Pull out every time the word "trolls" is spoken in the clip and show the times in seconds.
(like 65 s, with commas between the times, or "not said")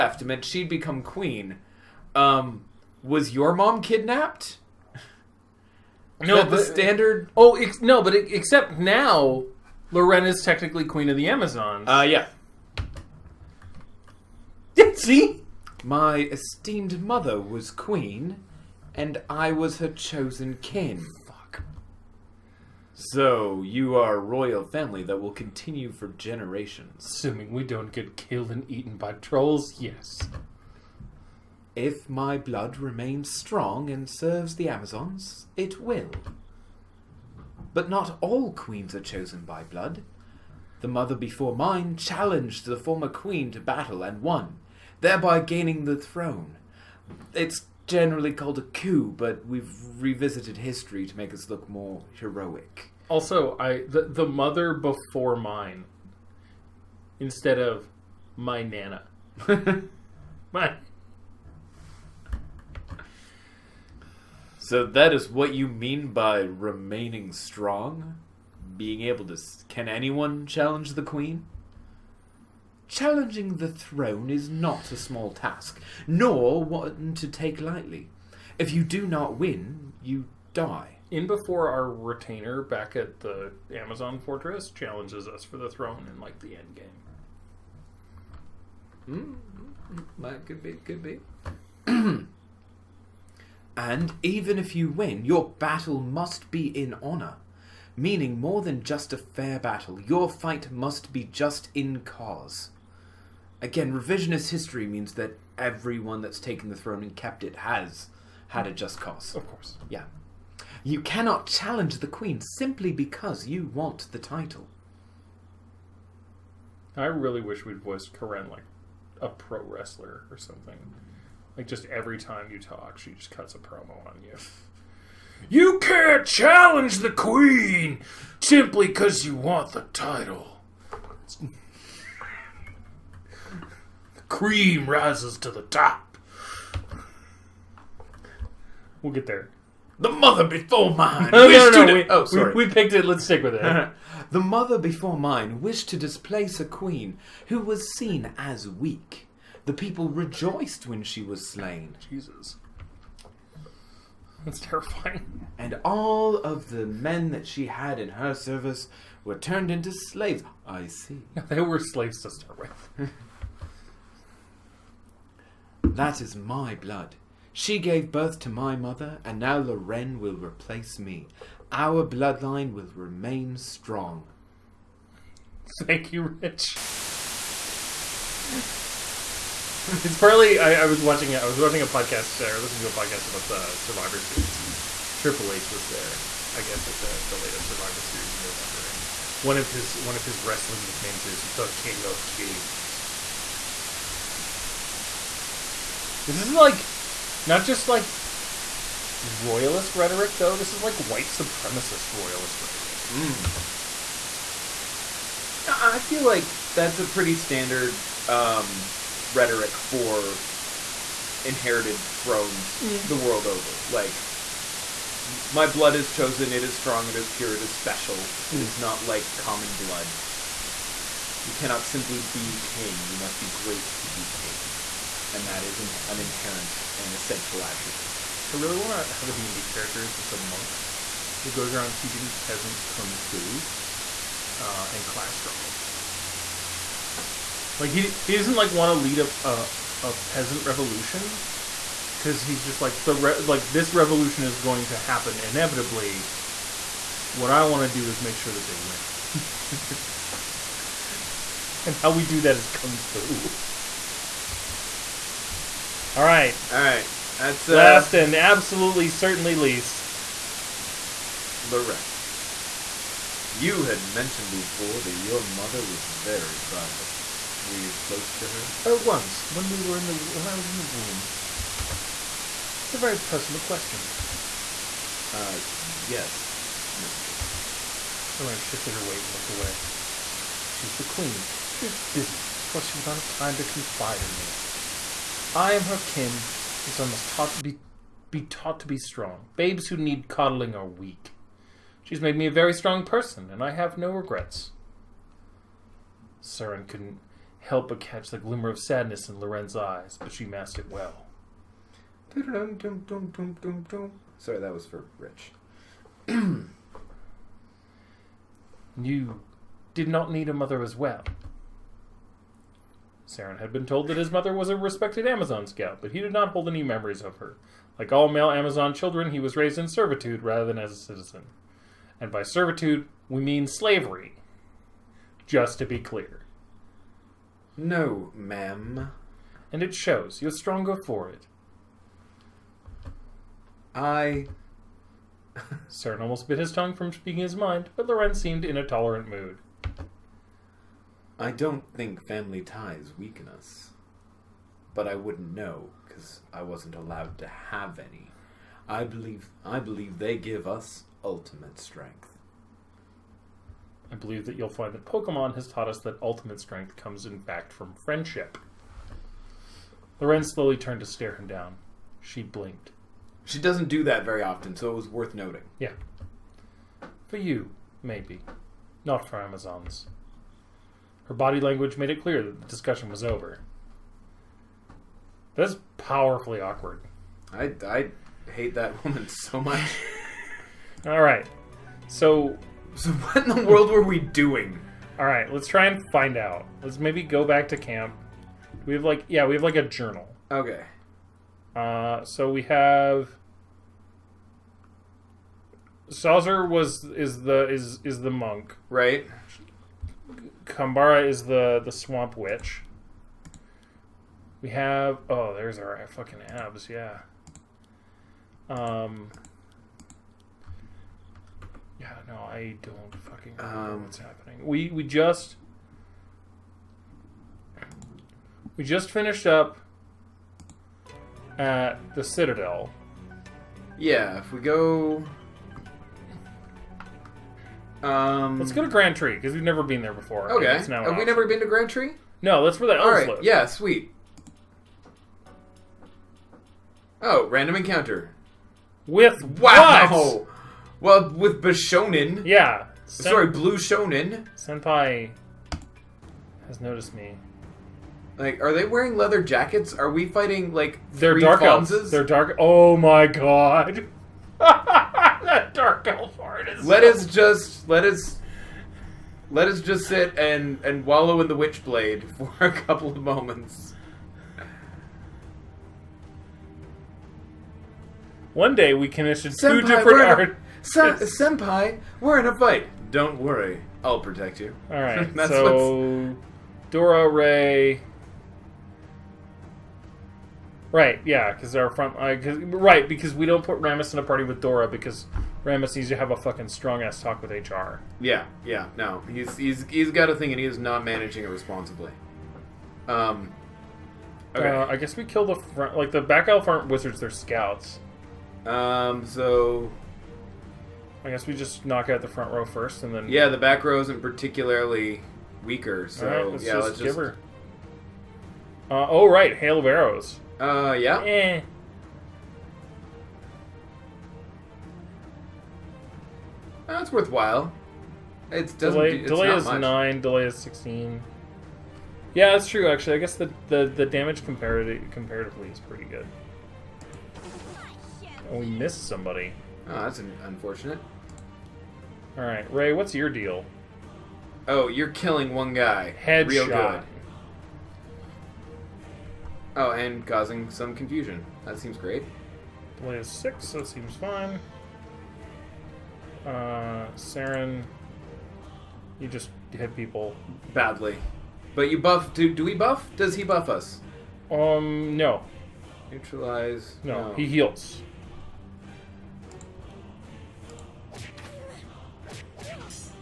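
29 s.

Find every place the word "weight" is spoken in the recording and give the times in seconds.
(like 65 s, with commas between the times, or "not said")
279 s.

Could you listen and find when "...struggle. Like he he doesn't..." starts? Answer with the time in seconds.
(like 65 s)
235 s.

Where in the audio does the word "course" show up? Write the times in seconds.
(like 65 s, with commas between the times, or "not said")
109 s, 282 s.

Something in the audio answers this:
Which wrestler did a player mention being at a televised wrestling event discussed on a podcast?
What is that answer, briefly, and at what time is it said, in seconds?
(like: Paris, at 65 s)
Triple H, at 185 s.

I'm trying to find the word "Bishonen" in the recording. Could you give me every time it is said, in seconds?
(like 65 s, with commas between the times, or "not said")
441 s.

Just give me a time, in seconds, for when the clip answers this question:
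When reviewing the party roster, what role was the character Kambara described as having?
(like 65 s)
401 s.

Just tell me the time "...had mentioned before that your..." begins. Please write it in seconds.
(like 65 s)
263 s.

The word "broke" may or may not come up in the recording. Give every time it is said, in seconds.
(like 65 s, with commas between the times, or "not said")
not said.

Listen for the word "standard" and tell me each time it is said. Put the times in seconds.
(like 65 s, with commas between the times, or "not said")
6 s, 207 s.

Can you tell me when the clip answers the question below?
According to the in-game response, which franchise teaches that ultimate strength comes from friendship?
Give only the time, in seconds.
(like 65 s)
355 s.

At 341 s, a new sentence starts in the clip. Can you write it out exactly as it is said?
I don't think family ties weaken us.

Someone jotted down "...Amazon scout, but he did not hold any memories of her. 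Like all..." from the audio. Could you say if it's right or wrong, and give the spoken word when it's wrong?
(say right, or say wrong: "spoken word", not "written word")
right.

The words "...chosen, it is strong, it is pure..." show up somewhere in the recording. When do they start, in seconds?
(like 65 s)
216 s.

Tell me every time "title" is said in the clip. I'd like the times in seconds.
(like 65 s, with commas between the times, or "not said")
114 s, 129 s.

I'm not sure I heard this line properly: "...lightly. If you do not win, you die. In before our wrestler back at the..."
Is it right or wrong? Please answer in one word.
wrong.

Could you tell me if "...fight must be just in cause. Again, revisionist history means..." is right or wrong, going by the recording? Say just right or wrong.
right.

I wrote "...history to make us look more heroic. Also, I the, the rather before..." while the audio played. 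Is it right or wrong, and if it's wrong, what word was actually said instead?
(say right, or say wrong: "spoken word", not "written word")
wrong: "mother", not "rather".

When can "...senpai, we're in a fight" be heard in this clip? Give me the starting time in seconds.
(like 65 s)
470 s.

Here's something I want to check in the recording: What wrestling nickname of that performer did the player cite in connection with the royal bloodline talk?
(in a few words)
King of Kings.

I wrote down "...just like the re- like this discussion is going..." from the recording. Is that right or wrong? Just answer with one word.
wrong.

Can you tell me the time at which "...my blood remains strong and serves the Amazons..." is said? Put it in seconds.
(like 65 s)
32 s.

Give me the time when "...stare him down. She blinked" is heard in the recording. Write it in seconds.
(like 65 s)
361 s.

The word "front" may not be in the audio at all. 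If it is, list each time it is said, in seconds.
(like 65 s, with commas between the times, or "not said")
481 s, 495 s, 502 s.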